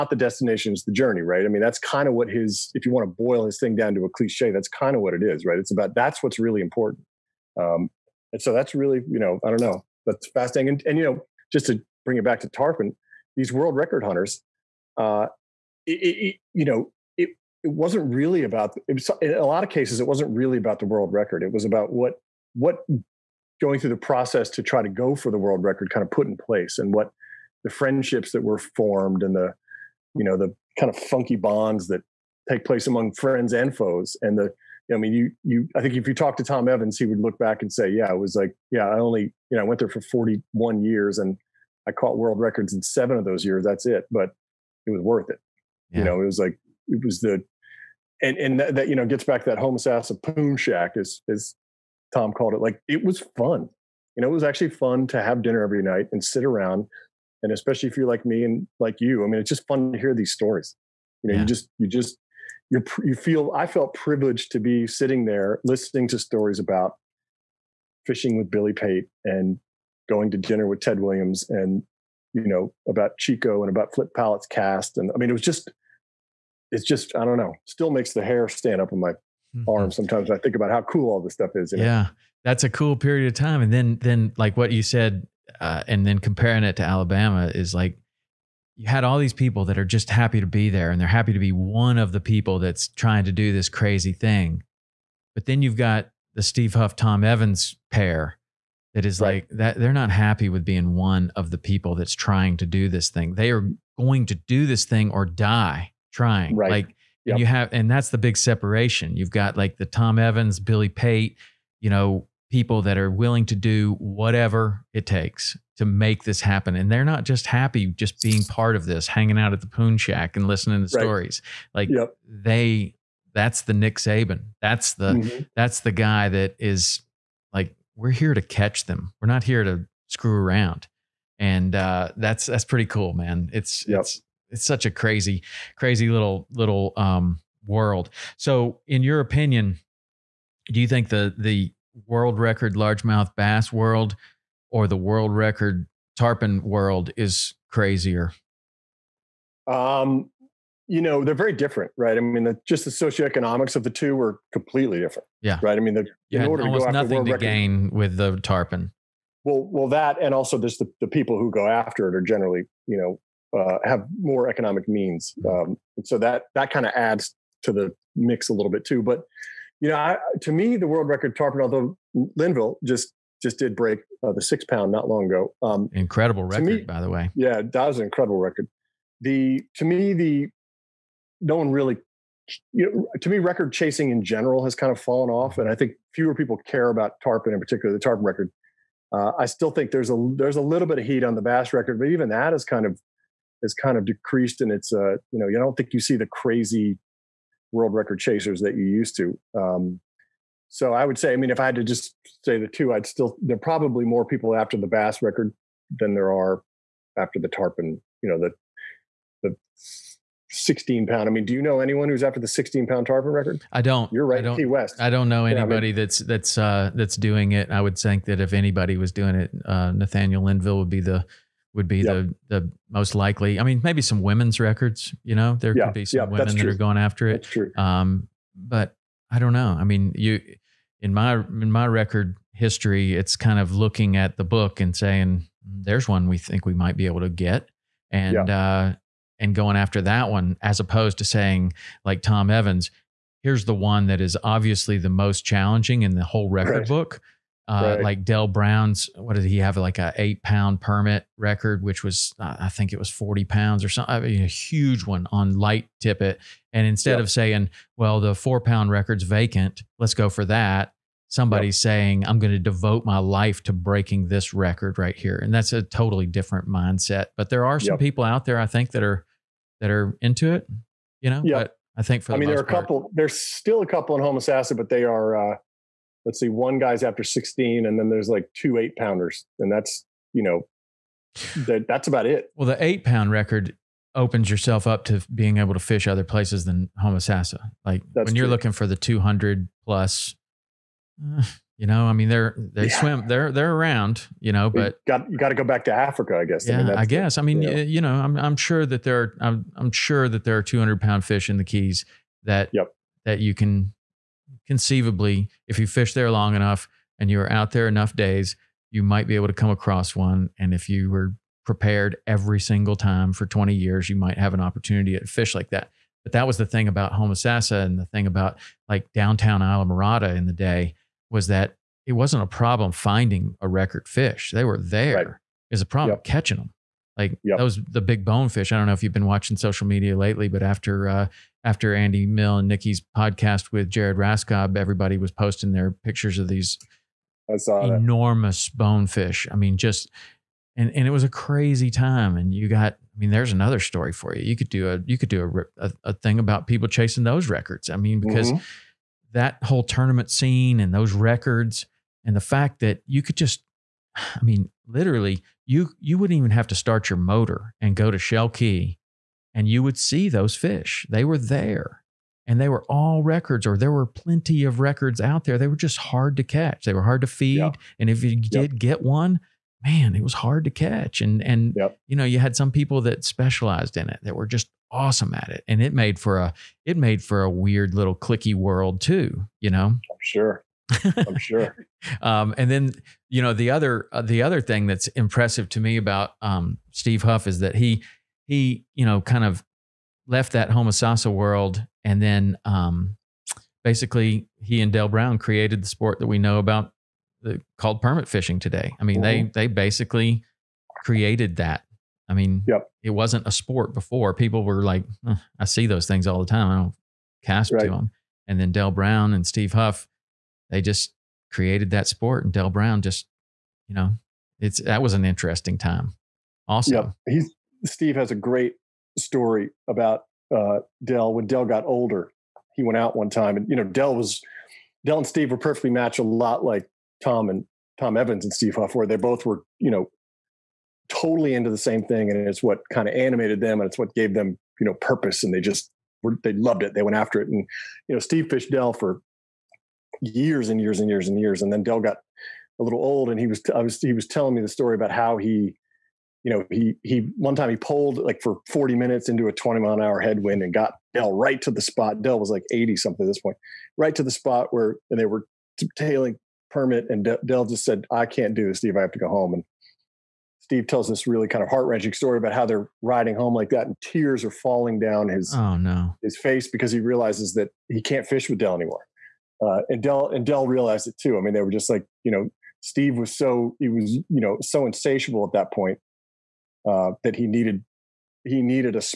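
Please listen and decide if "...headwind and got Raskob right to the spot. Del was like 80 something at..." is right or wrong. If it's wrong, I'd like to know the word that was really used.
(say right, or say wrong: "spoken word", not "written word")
wrong: "Del", not "Raskob".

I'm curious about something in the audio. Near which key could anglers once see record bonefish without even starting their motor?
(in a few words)
Shell Key.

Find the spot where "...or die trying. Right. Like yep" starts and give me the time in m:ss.
1:45.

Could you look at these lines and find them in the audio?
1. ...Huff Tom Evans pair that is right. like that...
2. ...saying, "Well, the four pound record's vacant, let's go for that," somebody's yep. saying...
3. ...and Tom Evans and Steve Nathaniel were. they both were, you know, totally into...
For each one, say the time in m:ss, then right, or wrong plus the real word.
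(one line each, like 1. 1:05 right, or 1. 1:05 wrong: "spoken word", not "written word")
1. 1:36 right
2. 4:17 right
3. 7:07 wrong: "Huff", not "Nathaniel".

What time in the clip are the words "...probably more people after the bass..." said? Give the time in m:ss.
3:23.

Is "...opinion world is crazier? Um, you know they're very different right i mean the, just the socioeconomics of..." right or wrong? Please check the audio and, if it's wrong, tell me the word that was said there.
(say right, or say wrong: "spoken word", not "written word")
wrong: "tarpon", not "opinion".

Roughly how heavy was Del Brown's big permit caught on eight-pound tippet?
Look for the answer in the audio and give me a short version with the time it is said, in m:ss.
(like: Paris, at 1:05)
40 pounds, at 4:13.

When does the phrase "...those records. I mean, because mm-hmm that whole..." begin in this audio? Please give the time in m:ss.
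5:47.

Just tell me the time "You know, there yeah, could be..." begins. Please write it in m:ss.
3:45.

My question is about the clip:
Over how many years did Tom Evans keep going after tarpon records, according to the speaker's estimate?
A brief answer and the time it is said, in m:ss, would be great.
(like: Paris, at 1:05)
41, at 0:39.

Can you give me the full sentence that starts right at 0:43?
That's it, but it was worth it.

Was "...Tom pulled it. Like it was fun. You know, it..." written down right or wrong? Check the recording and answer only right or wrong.
wrong.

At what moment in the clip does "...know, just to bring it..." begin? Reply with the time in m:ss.
0:11.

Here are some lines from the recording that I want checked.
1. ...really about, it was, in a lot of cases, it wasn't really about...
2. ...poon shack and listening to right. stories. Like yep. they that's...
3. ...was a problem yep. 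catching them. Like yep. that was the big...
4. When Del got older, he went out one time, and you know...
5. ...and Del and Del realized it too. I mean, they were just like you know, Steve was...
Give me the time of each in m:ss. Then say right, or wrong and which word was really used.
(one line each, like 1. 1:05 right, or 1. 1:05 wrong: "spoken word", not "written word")
1. 0:18 right
2. 1:59 right
3. 5:25 right
4. 7:01 right
5. 7:49 right.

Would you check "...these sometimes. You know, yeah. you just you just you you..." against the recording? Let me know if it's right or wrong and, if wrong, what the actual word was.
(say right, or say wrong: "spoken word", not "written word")
wrong: "stories", not "sometimes".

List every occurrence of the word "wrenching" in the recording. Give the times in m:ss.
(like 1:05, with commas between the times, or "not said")
7:41.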